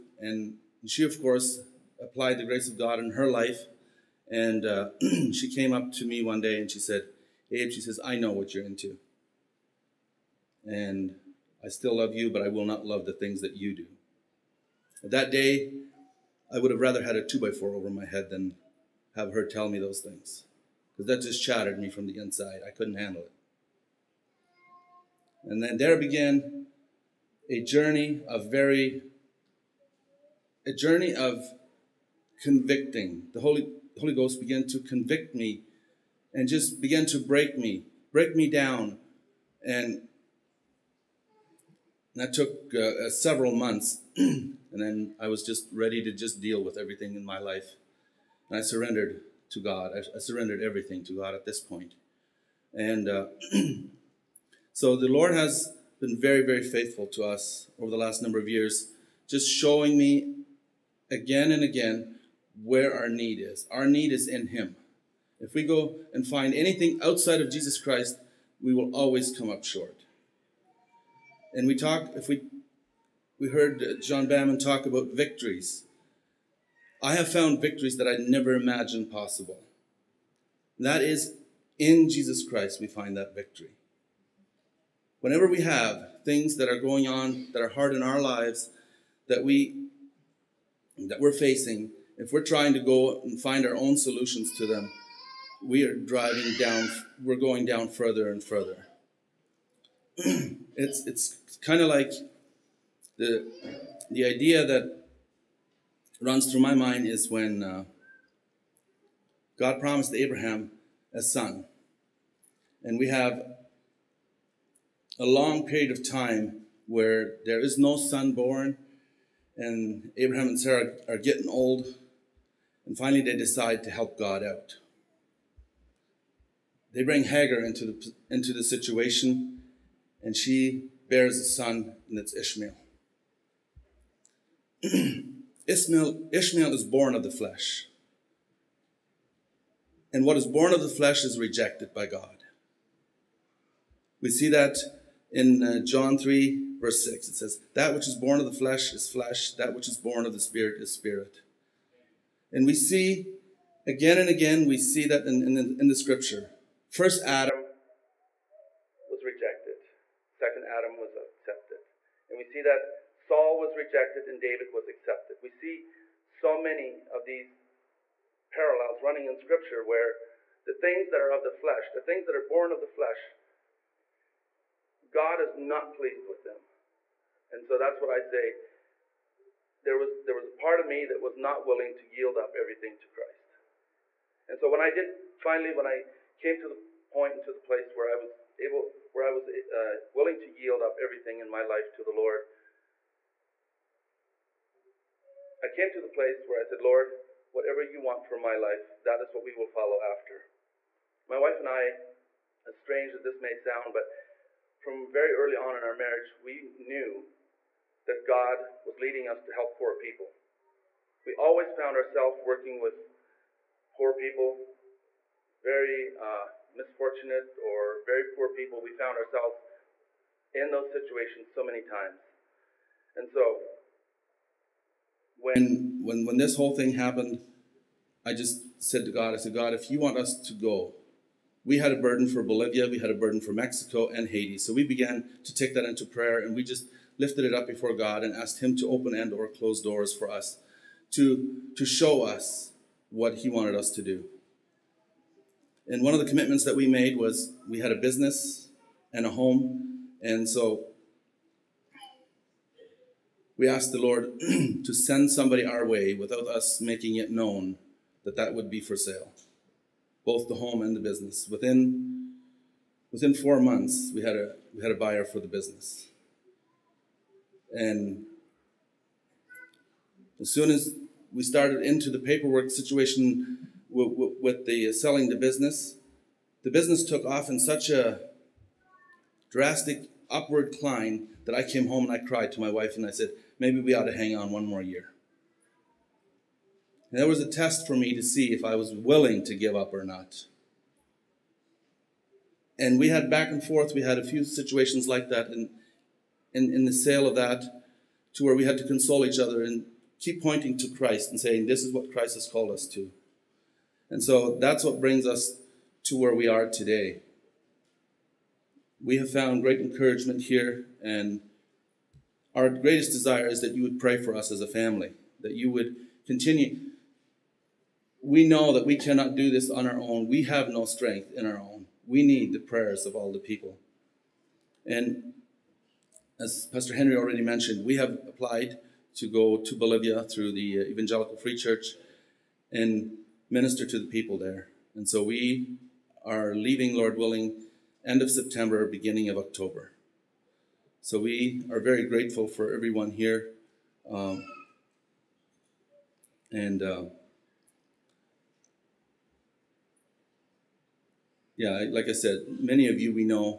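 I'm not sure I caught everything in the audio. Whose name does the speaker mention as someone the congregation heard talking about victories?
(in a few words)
John Bamman.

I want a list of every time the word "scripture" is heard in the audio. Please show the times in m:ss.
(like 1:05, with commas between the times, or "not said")
2:35, 2:49.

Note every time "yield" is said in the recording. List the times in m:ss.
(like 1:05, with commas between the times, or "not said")
3:02, 3:10.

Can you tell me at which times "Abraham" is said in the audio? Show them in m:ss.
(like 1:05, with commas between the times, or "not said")
1:50, 2:00.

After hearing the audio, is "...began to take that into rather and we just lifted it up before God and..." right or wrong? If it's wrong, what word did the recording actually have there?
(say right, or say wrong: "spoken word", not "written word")
wrong: "prayer", not "rather".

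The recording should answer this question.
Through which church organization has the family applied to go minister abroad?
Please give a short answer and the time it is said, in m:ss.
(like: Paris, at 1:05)
Evangelical Free Church, at 5:30.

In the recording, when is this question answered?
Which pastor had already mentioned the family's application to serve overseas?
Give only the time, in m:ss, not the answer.
5:26.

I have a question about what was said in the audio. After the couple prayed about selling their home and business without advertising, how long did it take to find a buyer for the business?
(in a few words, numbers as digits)
4 months.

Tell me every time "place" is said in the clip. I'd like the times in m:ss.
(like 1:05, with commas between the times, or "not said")
3:07, 3:16.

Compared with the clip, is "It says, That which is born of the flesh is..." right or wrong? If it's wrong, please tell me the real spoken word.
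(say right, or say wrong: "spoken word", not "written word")
right.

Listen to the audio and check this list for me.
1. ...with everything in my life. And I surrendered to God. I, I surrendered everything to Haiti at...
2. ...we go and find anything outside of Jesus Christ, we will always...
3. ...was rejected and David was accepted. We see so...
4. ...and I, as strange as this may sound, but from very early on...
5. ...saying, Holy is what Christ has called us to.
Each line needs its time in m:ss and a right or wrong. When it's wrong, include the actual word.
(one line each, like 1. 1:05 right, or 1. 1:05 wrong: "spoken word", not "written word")
1. 0:46 wrong: "God", not "Haiti"
2. 1:05 right
3. 2:43 right
4. 3:21 right
5. 5:01 wrong: "This", not "Holy".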